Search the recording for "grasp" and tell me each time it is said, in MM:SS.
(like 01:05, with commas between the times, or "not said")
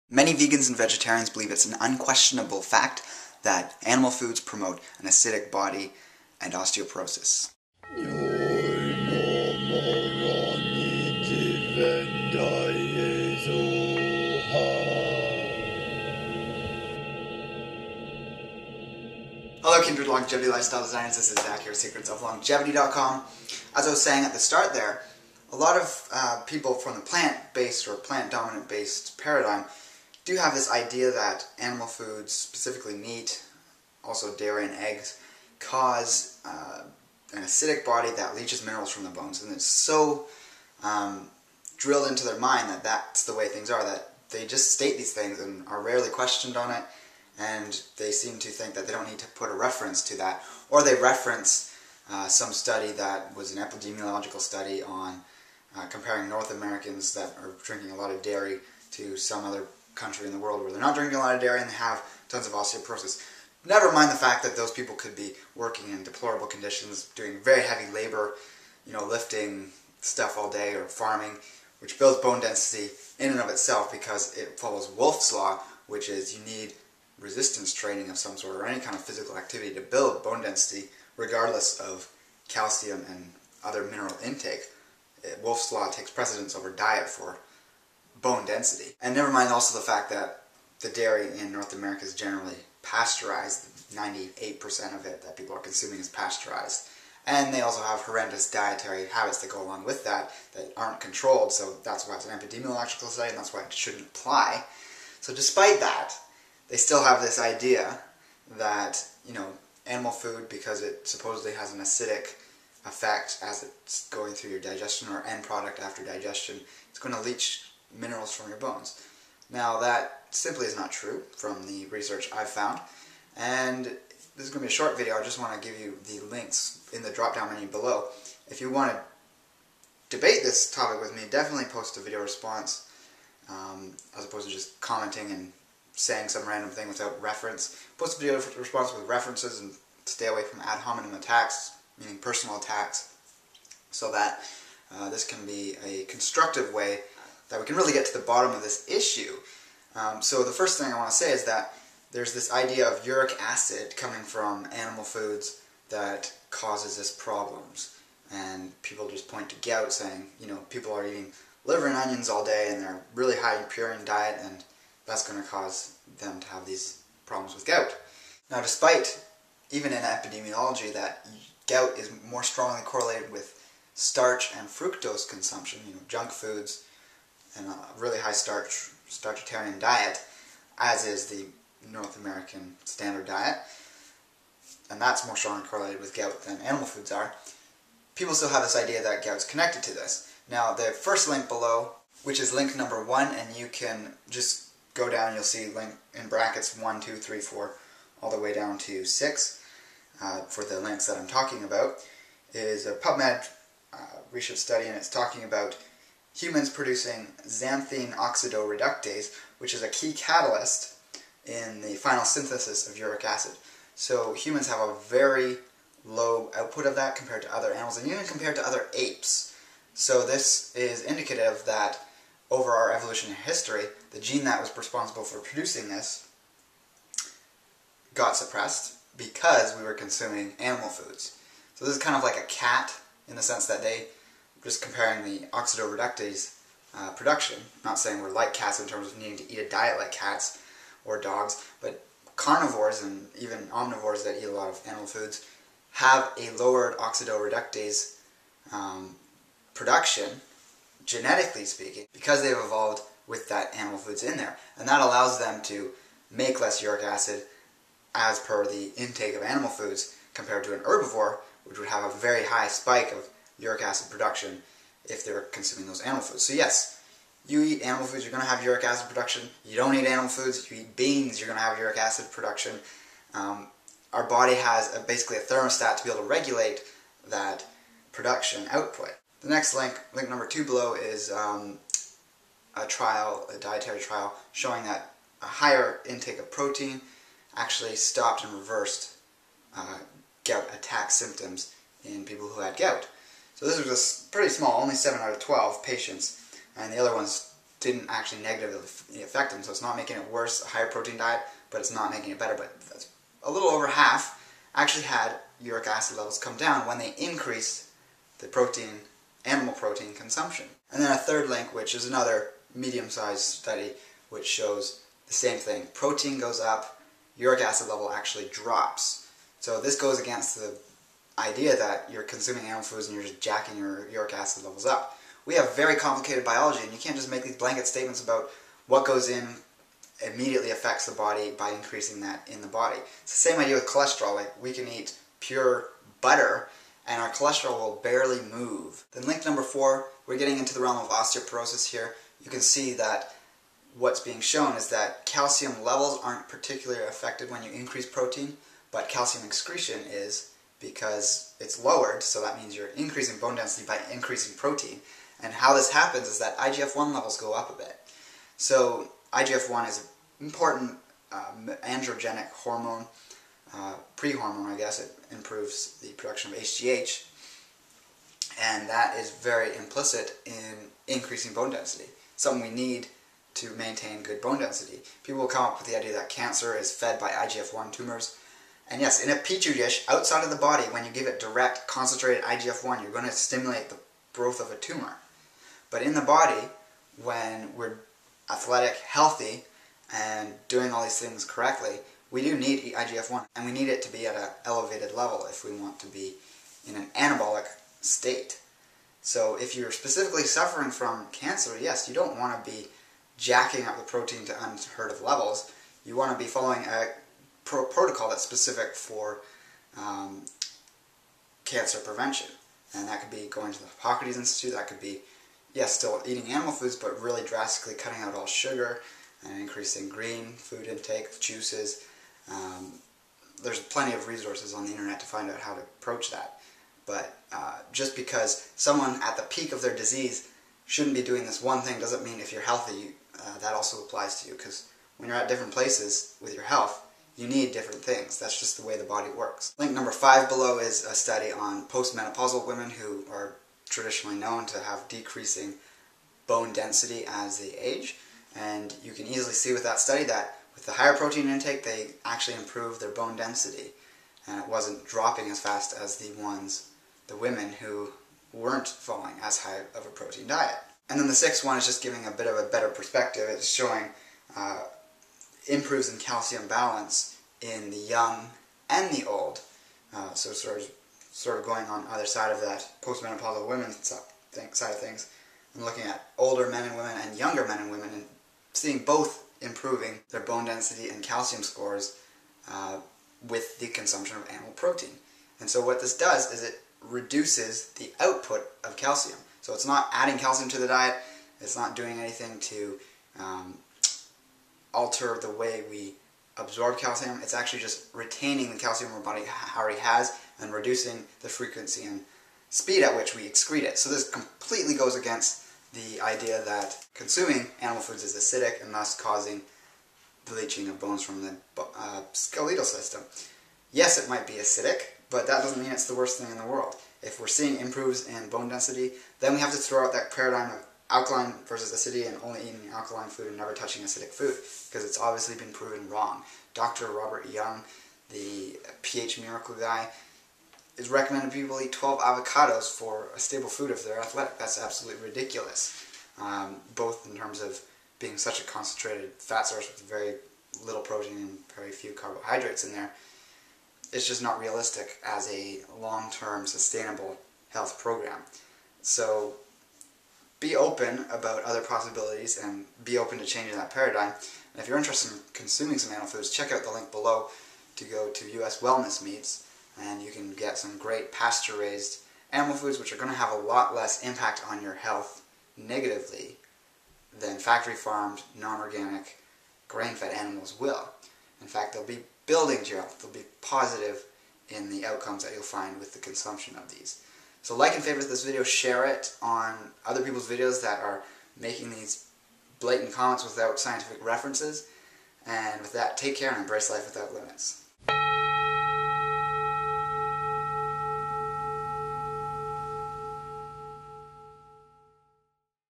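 not said.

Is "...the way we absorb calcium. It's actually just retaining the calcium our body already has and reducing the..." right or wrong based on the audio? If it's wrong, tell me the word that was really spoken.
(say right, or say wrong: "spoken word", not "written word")
right.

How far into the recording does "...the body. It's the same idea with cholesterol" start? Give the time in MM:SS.
05:32.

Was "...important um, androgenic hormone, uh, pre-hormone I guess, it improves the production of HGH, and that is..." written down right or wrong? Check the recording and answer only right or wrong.
right.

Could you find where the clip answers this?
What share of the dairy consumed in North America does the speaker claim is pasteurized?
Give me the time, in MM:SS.
01:33.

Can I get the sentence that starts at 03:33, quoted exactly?
So humans have a very low output of that compared to other animals and even compared to other apes.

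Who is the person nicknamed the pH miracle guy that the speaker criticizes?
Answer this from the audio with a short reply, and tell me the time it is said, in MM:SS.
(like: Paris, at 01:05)
Robert Young, at 08:47.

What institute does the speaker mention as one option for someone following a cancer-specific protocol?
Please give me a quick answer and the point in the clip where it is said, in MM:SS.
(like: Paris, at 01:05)
Hippocrates Institute, at 06:53.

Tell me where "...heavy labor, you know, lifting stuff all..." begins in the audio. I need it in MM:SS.
01:07.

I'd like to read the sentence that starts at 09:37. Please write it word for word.
So like and favorite this video, share it on other people's videos that are making these blatant comments without scientific references.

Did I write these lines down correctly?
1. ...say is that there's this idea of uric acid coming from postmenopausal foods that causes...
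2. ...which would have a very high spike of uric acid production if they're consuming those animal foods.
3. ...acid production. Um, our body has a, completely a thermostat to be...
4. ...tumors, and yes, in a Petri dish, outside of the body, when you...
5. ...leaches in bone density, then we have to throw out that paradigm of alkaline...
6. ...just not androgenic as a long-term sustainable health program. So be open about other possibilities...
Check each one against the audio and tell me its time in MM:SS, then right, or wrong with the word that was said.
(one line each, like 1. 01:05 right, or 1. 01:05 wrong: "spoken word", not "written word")
1. 02:31 wrong: "animal", not "postmenopausal"
2. 04:21 right
3. 04:31 wrong: "basically", not "completely"
4. 06:17 right
5. 08:37 wrong: "improves", not "leaches"
6. 09:04 wrong: "realistic", not "androgenic".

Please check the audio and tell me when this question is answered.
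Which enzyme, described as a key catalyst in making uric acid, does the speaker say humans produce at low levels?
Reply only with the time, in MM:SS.
03:27.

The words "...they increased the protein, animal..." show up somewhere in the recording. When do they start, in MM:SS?
05:06.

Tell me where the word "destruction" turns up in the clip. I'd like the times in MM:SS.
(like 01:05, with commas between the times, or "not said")
not said.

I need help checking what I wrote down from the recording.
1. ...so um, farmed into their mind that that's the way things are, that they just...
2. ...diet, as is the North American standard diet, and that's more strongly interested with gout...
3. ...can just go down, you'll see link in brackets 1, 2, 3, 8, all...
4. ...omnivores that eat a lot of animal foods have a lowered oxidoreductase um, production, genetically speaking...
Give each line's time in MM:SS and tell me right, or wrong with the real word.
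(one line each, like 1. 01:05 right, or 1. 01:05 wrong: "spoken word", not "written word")
1. 00:39 wrong: "drilled", not "farmed"
2. 02:59 wrong: "correlated", not "interested"
3. 03:13 wrong: "4", not "8"
4. 04:03 right.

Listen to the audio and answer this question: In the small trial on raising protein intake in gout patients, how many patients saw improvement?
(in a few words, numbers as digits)
7.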